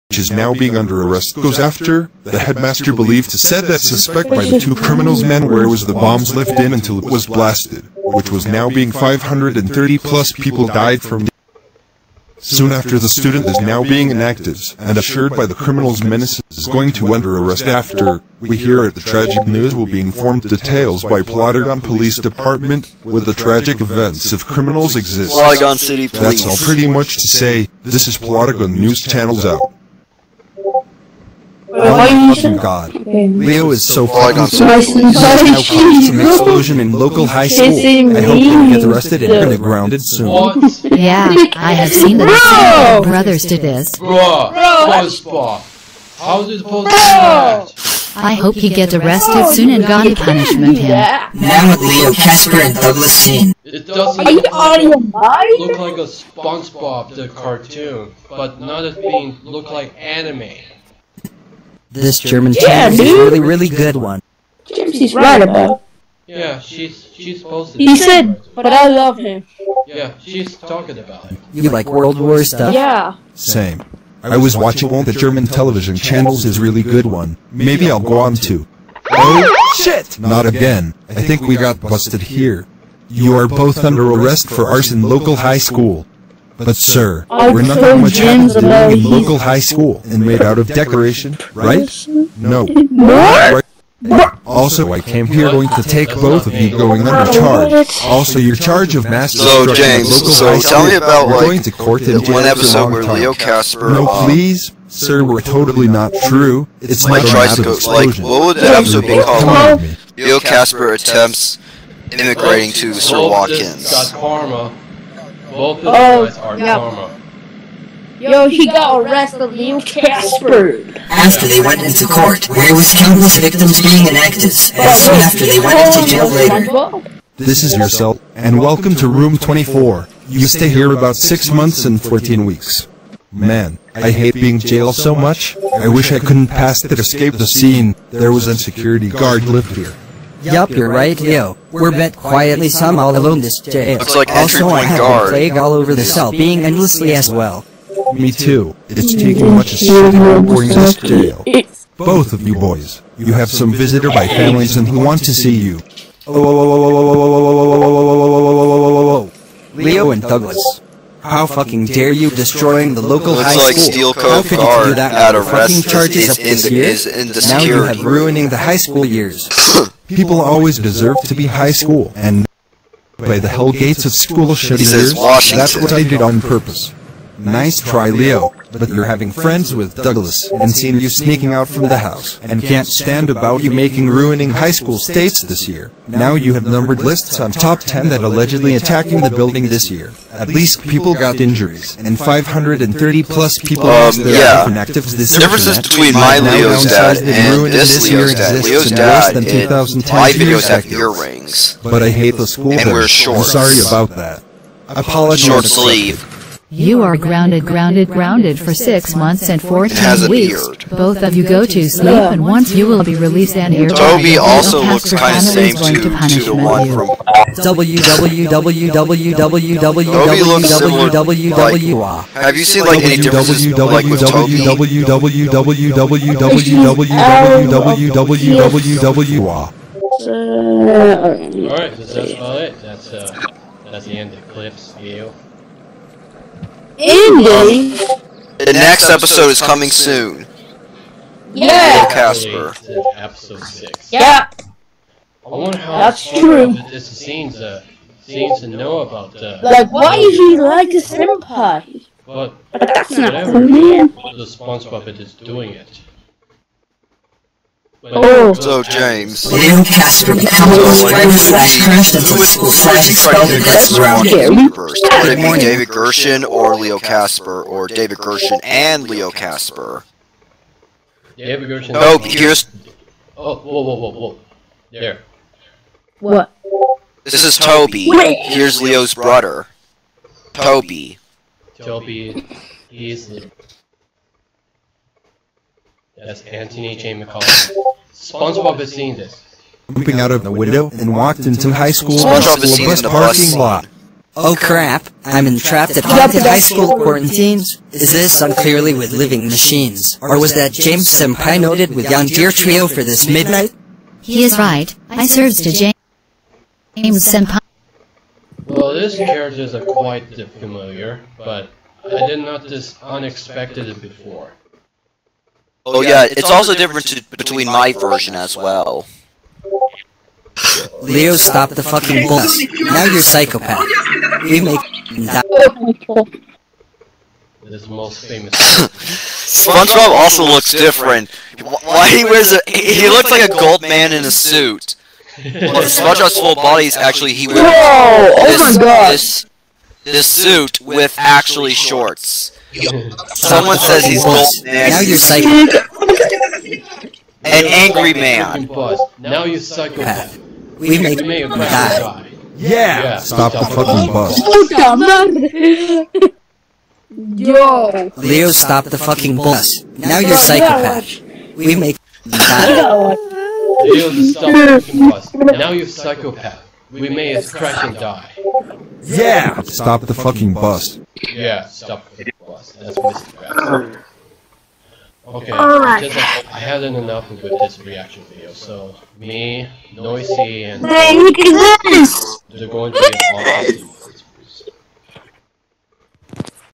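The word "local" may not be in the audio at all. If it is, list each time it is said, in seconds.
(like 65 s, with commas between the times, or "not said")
36 s, 85 s, 89 s, 163 s.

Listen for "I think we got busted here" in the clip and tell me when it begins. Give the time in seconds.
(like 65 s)
81 s.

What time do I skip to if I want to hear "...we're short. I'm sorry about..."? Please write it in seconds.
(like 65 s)
202 s.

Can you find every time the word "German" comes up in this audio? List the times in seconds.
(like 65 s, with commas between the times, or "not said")
62 s, 75 s.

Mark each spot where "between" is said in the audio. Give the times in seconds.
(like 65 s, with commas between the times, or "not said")
195 s, 317 s.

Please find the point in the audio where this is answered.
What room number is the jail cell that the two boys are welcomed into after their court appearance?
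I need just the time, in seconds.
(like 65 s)
129 s.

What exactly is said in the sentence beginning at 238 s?
The next episode is coming soon.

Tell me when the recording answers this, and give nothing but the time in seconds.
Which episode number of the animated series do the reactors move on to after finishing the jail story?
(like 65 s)
243 s.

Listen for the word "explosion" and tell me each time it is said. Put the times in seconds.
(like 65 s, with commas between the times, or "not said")
36 s.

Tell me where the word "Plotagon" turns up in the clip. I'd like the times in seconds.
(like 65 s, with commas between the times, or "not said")
21 s, 28 s.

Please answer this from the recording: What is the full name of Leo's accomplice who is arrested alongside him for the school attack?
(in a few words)
Douglas Sin.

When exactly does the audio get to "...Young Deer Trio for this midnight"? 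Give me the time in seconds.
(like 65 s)
302 s.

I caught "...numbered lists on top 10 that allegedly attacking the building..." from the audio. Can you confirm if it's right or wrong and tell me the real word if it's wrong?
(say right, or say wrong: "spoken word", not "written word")
right.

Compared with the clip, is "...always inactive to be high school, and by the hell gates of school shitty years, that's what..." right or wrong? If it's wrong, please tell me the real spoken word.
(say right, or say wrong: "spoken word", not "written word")
wrong: "deserve", not "inactive".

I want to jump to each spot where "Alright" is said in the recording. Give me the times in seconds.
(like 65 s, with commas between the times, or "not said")
230 s, 375 s.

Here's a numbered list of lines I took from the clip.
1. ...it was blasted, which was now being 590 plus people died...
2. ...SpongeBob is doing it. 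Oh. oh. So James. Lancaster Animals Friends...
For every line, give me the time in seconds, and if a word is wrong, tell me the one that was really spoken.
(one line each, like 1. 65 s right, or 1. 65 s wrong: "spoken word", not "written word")
1. 7 s wrong: "530", not "590"
2. 254 s right.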